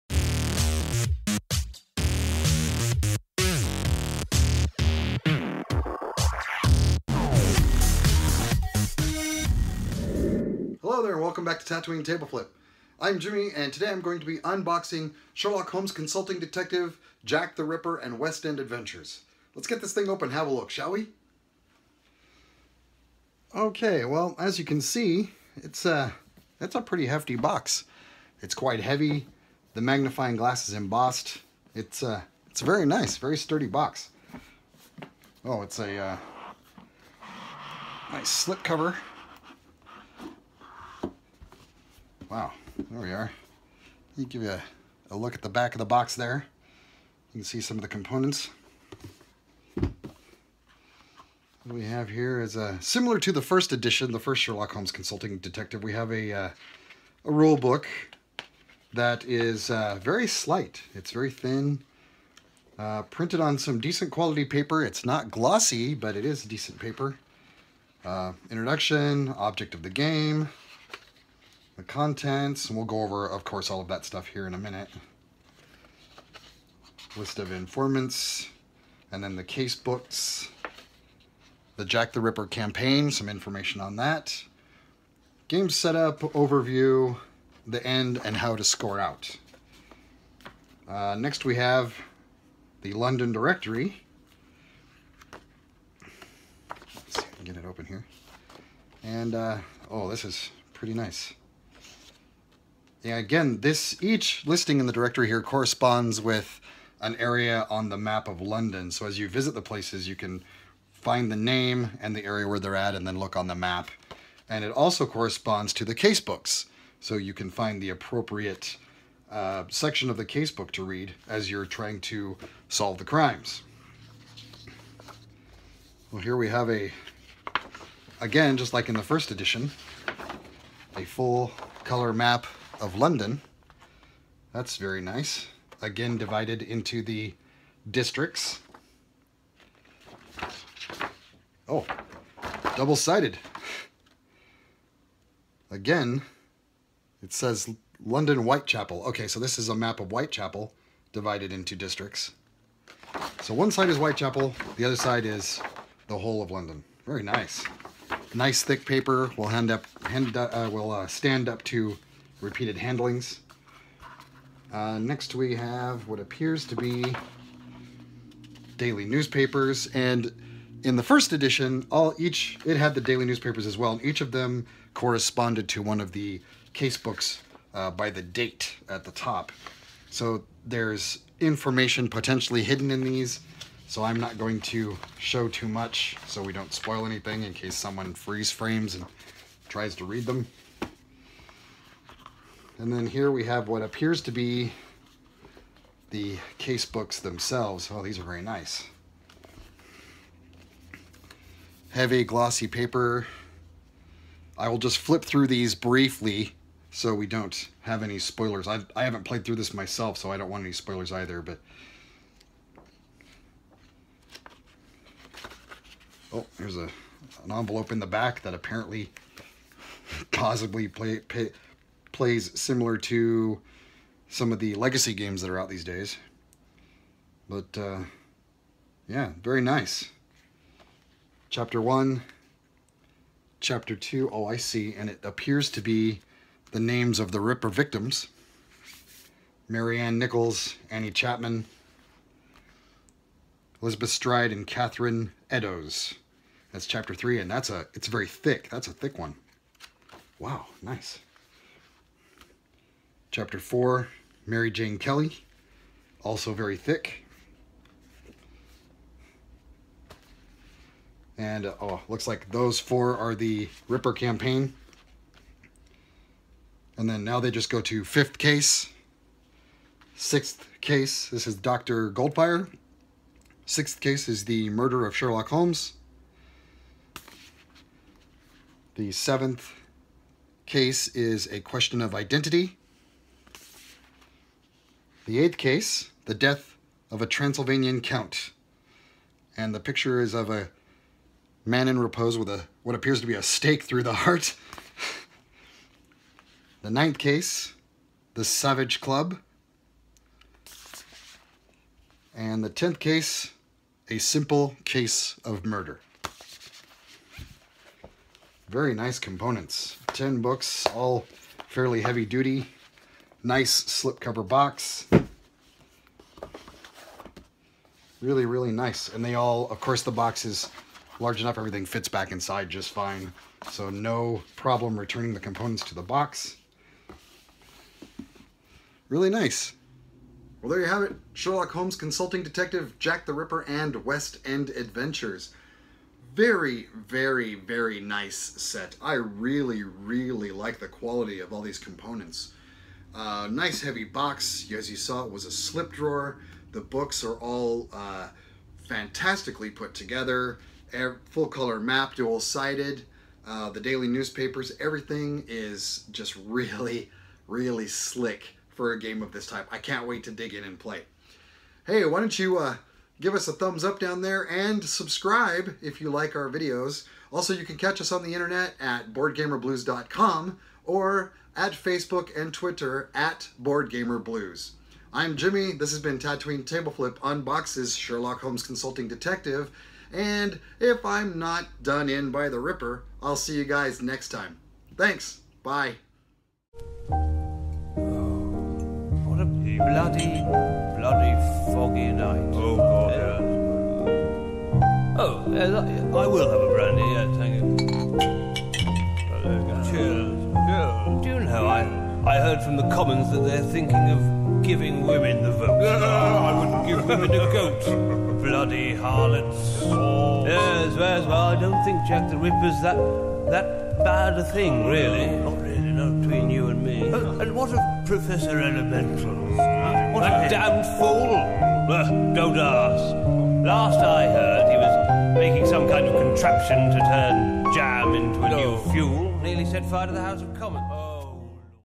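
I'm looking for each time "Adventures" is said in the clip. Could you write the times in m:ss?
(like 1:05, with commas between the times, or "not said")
0:18, 5:34.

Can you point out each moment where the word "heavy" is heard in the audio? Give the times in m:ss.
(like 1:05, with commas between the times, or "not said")
0:28, 3:21, 5:12, 5:43.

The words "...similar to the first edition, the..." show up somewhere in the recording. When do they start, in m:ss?
0:52.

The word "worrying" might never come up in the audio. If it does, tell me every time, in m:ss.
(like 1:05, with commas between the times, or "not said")
not said.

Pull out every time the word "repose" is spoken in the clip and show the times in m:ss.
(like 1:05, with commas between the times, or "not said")
4:51.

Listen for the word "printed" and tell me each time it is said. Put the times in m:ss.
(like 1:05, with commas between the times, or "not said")
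1:03.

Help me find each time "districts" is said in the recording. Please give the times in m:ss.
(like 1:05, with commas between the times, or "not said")
2:17, 2:31.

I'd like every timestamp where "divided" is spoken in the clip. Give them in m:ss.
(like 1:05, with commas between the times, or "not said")
2:16, 2:31.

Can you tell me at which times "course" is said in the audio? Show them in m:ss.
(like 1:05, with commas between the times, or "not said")
1:13, 5:19.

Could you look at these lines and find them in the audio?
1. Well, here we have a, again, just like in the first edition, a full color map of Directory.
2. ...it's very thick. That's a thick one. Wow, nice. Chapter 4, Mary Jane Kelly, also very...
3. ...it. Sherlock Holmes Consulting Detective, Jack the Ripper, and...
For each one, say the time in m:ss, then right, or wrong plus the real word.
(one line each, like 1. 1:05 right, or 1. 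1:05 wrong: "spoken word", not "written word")
1. 2:06 wrong: "London", not "Directory"
2. 4:07 right
3. 5:31 right.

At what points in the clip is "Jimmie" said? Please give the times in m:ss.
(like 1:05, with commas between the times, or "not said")
0:13, 6:15.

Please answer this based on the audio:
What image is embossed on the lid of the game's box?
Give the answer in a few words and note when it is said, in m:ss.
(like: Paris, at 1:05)
The magnifying glass, at 0:29.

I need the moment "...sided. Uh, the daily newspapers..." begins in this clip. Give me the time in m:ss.
5:52.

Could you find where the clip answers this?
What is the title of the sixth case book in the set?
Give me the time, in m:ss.
4:34.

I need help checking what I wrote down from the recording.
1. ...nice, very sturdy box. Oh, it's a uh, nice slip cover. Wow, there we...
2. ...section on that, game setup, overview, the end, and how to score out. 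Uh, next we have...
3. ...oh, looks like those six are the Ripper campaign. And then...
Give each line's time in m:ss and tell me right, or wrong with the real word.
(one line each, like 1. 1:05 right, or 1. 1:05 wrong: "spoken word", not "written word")
1. 0:32 right
2. 1:23 wrong: "information", not "section"
3. 4:21 wrong: "four", not "six".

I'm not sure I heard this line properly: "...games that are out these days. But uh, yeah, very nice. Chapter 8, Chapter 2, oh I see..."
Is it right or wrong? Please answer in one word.
wrong.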